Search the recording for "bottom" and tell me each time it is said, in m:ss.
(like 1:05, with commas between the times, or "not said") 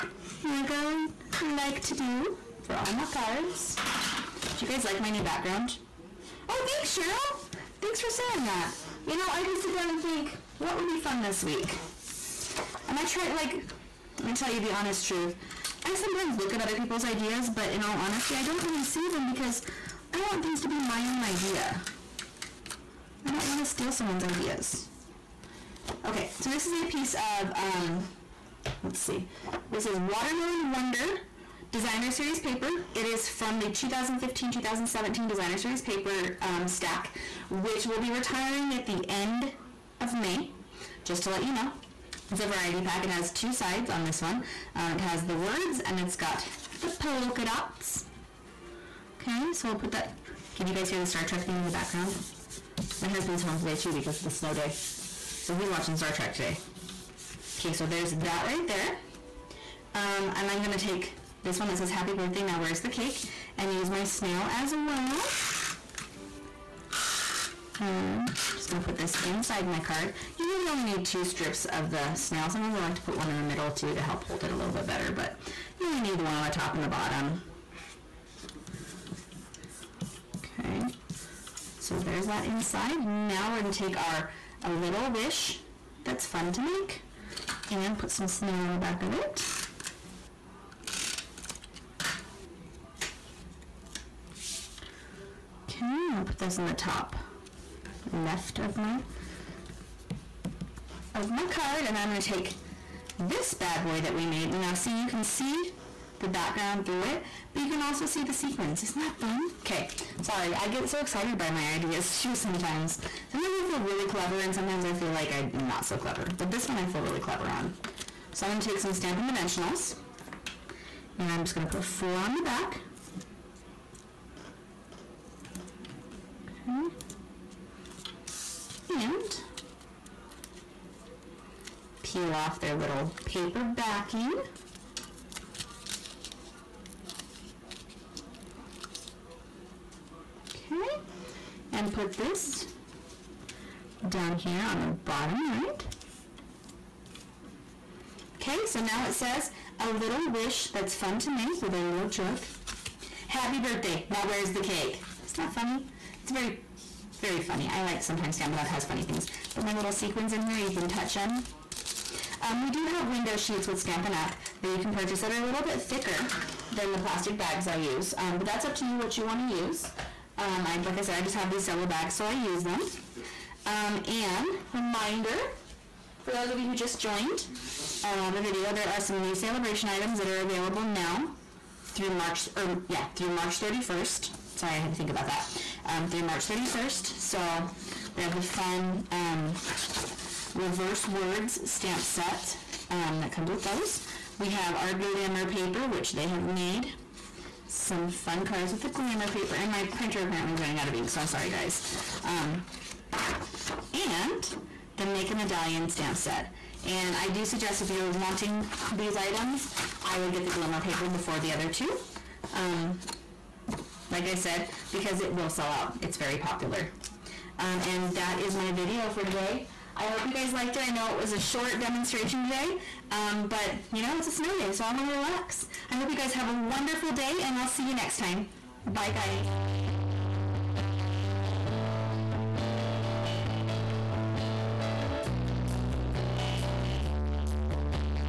1:16, 2:24.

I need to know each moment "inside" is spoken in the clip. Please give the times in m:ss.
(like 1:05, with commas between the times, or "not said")
1:09, 1:22.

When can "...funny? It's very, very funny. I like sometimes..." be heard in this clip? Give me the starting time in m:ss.
2:35.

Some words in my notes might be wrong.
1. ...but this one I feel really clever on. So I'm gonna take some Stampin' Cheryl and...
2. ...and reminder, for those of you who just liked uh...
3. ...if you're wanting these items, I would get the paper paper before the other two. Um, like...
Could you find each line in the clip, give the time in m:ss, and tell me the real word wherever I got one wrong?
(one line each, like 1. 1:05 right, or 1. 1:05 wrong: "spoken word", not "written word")
1. 1:56 wrong: "Dimensionals", not "Cheryl"
2. 2:54 wrong: "joined", not "liked"
3. 3:27 wrong: "glimmer", not "paper".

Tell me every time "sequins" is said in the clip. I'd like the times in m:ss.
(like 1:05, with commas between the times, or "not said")
1:48, 2:39.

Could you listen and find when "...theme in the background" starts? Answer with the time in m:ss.
0:51.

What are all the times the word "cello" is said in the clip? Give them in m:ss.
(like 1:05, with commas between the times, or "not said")
2:51.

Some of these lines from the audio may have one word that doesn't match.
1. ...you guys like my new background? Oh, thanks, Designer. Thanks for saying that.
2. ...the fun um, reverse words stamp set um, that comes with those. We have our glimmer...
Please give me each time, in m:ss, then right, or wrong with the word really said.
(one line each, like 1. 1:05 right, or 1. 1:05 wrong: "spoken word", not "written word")
1. 0:04 wrong: "Cheryl", not "Designer"
2. 3:08 right.